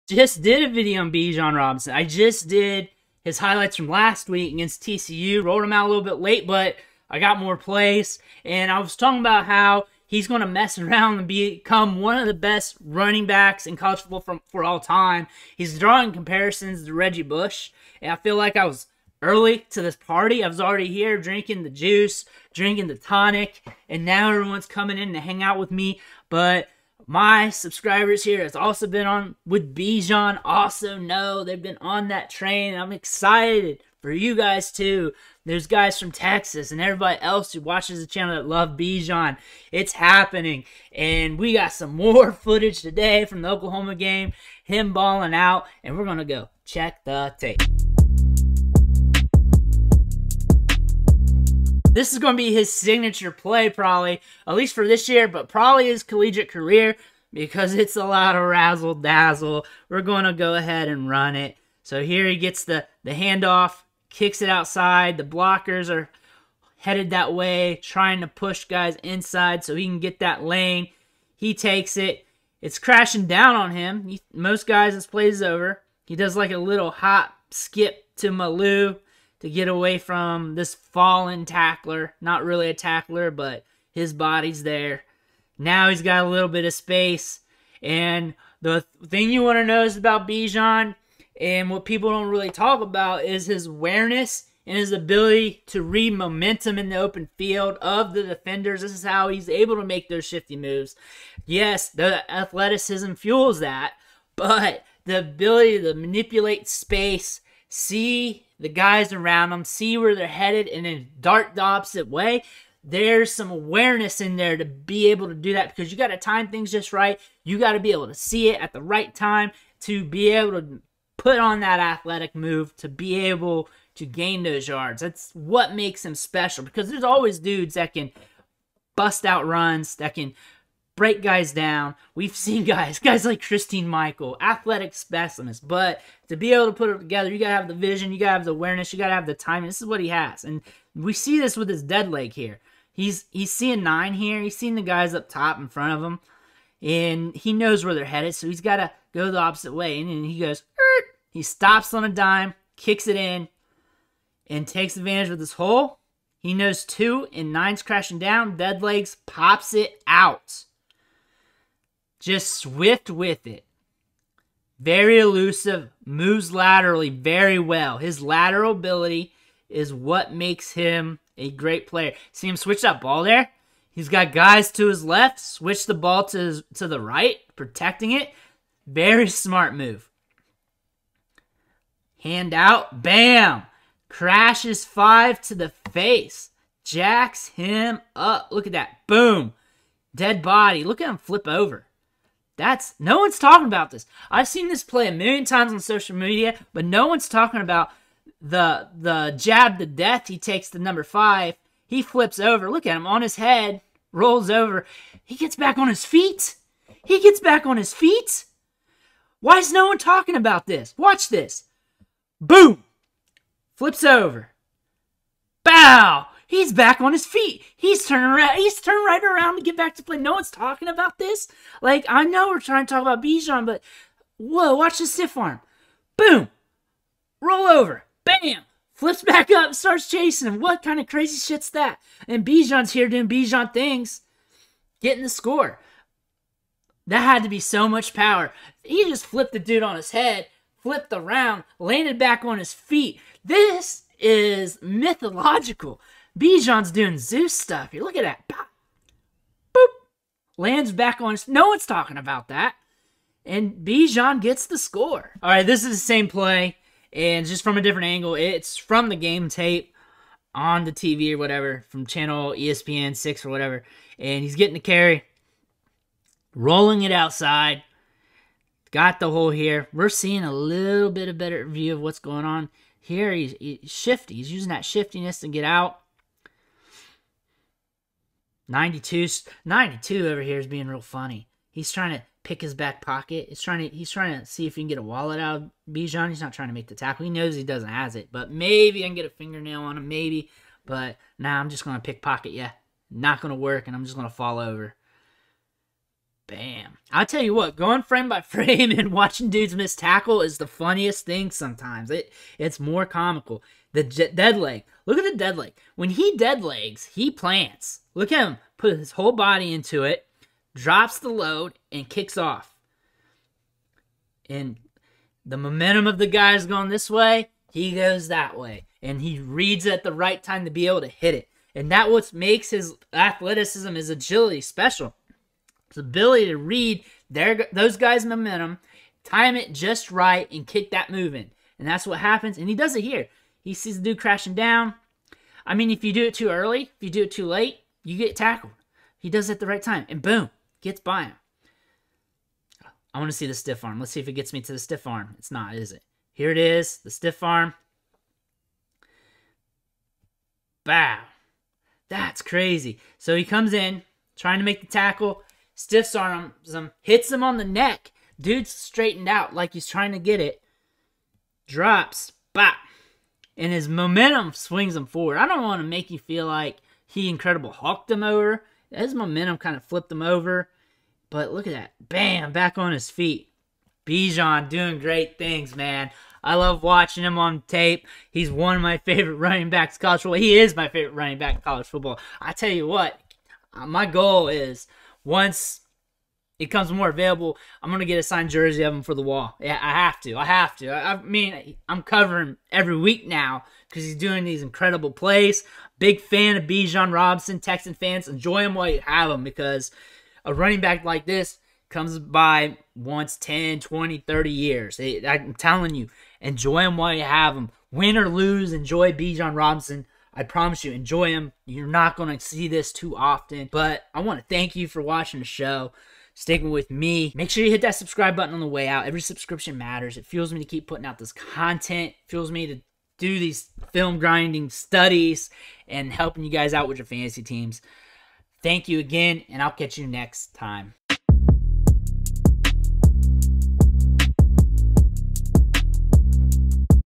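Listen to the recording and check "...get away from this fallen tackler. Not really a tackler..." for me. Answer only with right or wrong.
right.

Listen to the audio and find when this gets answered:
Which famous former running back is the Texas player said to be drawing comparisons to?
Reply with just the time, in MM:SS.
00:16.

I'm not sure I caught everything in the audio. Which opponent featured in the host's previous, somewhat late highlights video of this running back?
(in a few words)
TCU.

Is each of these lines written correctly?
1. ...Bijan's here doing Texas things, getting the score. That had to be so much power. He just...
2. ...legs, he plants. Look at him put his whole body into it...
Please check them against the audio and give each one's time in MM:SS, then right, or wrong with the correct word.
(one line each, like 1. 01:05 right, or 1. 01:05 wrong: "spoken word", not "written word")
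1. 03:52 wrong: "Bijan", not "Texas"
2. 05:06 right.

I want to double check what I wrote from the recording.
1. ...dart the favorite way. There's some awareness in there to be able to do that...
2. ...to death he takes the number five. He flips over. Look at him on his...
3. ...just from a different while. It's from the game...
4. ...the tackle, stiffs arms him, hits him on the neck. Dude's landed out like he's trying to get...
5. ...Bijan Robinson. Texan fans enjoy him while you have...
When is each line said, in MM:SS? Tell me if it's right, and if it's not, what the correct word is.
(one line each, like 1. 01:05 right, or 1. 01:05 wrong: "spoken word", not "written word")
1. 01:51 wrong: "opposite", not "favorite"
2. 03:19 right
3. 04:17 wrong: "angle", not "while"
4. 05:54 wrong: "straightened", not "landed"
5. 06:36 right.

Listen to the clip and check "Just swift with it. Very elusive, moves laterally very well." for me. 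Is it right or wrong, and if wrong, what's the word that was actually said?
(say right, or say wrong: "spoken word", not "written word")
right.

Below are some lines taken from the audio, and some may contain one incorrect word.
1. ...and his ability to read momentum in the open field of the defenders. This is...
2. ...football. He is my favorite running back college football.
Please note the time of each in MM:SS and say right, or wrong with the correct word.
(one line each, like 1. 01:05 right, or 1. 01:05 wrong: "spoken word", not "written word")
1. 01:34 right
2. 06:20 right.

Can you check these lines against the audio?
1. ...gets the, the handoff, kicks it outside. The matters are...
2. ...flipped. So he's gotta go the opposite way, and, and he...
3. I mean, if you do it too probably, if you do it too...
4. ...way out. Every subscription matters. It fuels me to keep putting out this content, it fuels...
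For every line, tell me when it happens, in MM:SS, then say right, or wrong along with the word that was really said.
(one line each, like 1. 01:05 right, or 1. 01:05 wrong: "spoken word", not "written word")
1. 01:02 wrong: "blockers", not "matters"
2. 02:28 wrong: "headed", not "flipped"
3. 05:35 wrong: "early", not "probably"
4. 06:58 right.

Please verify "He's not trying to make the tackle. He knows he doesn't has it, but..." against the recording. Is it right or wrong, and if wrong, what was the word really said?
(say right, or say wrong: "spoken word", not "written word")
right.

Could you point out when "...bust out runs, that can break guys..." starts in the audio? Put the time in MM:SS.
02:08.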